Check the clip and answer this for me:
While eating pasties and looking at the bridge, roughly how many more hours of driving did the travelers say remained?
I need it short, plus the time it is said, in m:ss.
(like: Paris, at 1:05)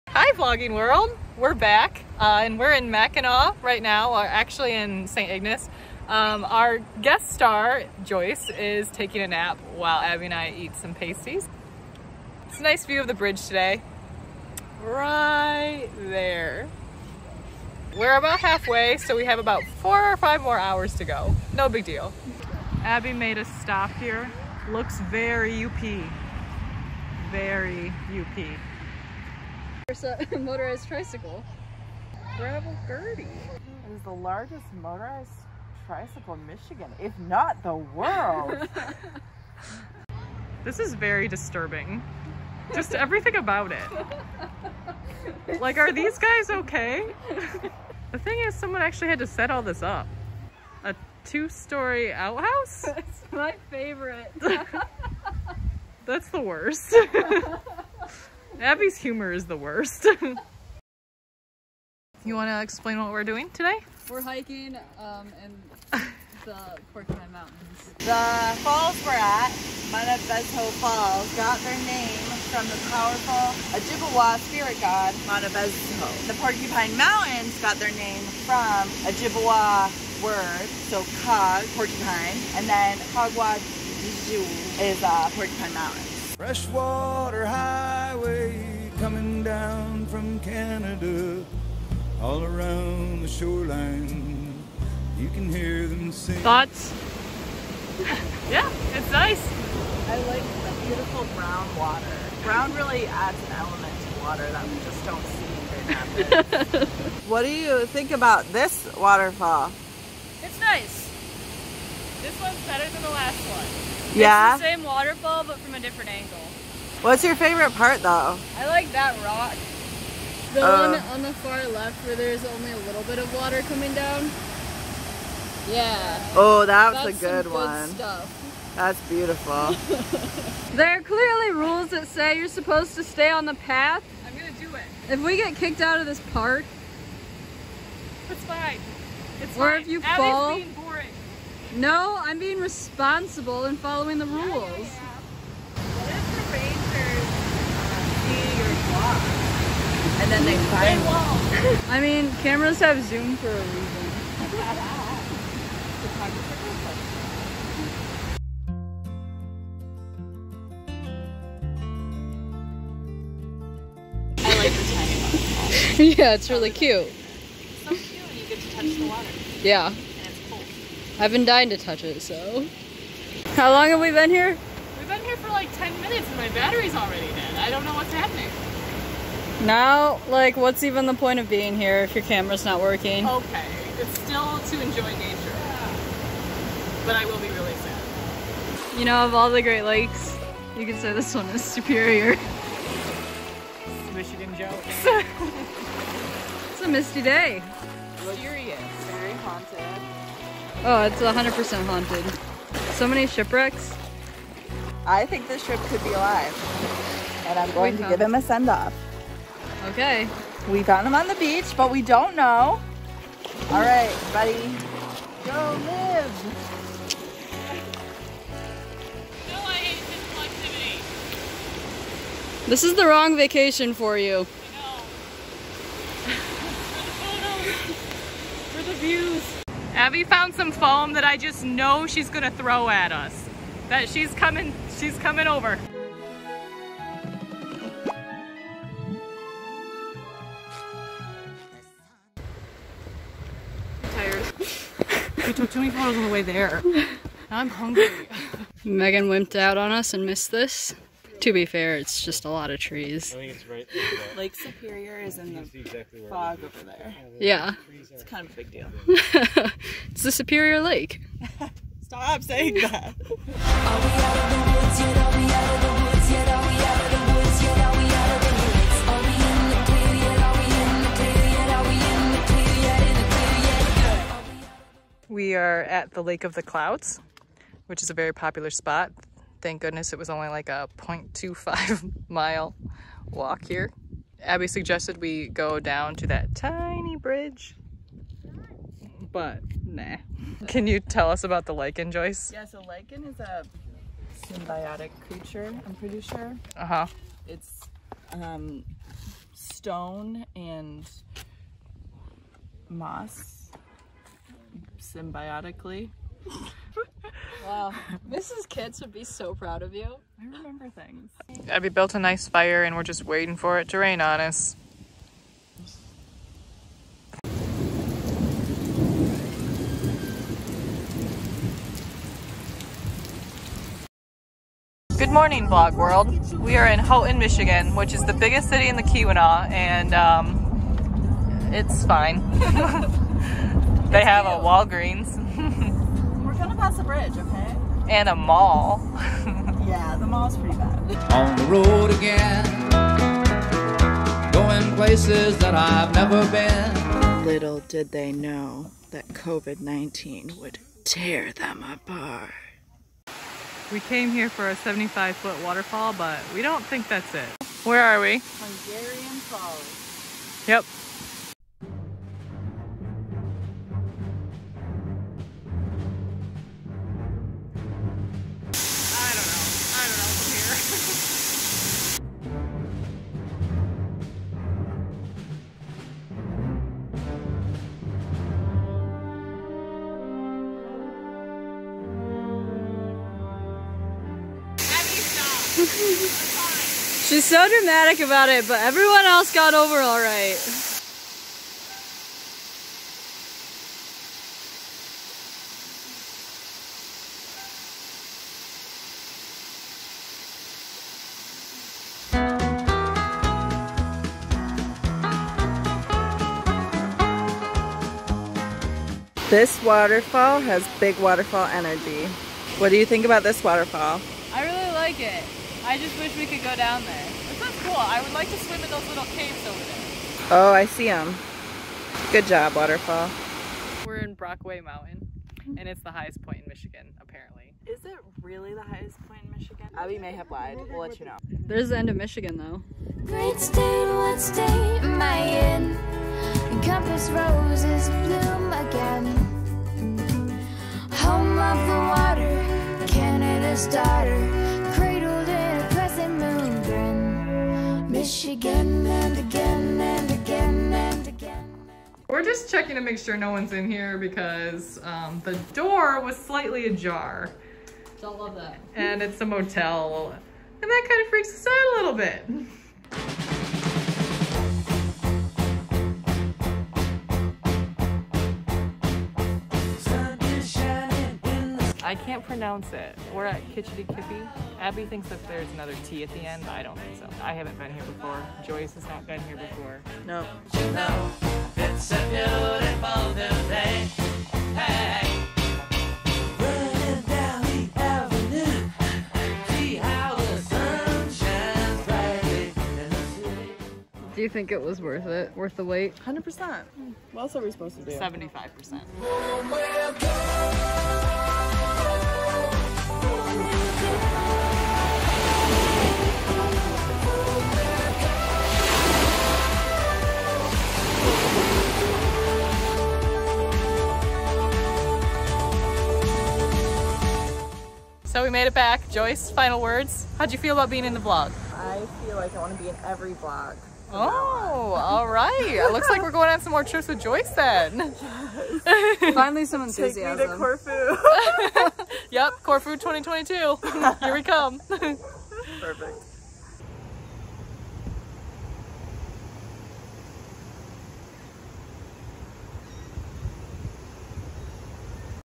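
4 or 5, at 0:19.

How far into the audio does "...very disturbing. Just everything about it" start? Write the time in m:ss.
0:40.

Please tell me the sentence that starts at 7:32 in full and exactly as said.
we're just checking to make sure no one's in here because um, the door was slightly ajar.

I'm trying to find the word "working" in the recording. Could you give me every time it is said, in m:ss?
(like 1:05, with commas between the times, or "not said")
3:02.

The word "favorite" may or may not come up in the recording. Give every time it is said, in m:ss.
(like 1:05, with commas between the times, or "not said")
0:53, 1:57.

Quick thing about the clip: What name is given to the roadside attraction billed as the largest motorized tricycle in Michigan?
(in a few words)
Gravel Gertie.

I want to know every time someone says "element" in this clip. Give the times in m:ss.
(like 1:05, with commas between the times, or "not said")
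1:43.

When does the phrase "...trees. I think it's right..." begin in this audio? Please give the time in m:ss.
4:12.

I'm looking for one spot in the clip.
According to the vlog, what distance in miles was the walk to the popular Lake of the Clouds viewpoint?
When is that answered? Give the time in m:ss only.
4:40.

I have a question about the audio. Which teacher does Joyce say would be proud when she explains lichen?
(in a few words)
Mrs. Kitts.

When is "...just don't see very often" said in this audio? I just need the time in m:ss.
1:44.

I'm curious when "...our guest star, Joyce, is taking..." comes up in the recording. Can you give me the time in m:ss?
0:06.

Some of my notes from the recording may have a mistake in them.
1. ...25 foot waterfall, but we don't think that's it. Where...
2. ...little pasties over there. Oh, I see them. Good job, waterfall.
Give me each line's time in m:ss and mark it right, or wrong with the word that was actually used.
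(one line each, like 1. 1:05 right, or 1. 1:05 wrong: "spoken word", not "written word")
1. 5:54 wrong: "75", not "25"
2. 6:59 wrong: "caves", not "pasties".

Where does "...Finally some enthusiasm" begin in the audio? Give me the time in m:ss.
8:49.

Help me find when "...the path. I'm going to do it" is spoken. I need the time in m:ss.
2:13.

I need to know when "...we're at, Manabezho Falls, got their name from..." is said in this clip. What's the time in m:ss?
1:09.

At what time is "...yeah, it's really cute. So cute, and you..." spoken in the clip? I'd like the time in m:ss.
2:46.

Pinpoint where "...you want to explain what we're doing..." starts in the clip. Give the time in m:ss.
1:02.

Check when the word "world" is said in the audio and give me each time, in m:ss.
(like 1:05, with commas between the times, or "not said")
0:00, 0:37, 5:25.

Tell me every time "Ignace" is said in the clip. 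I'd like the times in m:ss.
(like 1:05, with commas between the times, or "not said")
0:05.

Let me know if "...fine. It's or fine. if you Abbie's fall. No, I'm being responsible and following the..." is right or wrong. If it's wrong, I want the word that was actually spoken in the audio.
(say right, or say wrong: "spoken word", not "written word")
right.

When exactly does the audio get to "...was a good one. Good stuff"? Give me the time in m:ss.
2:07.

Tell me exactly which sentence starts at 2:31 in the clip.
I mean, cameras have zoom for a reason.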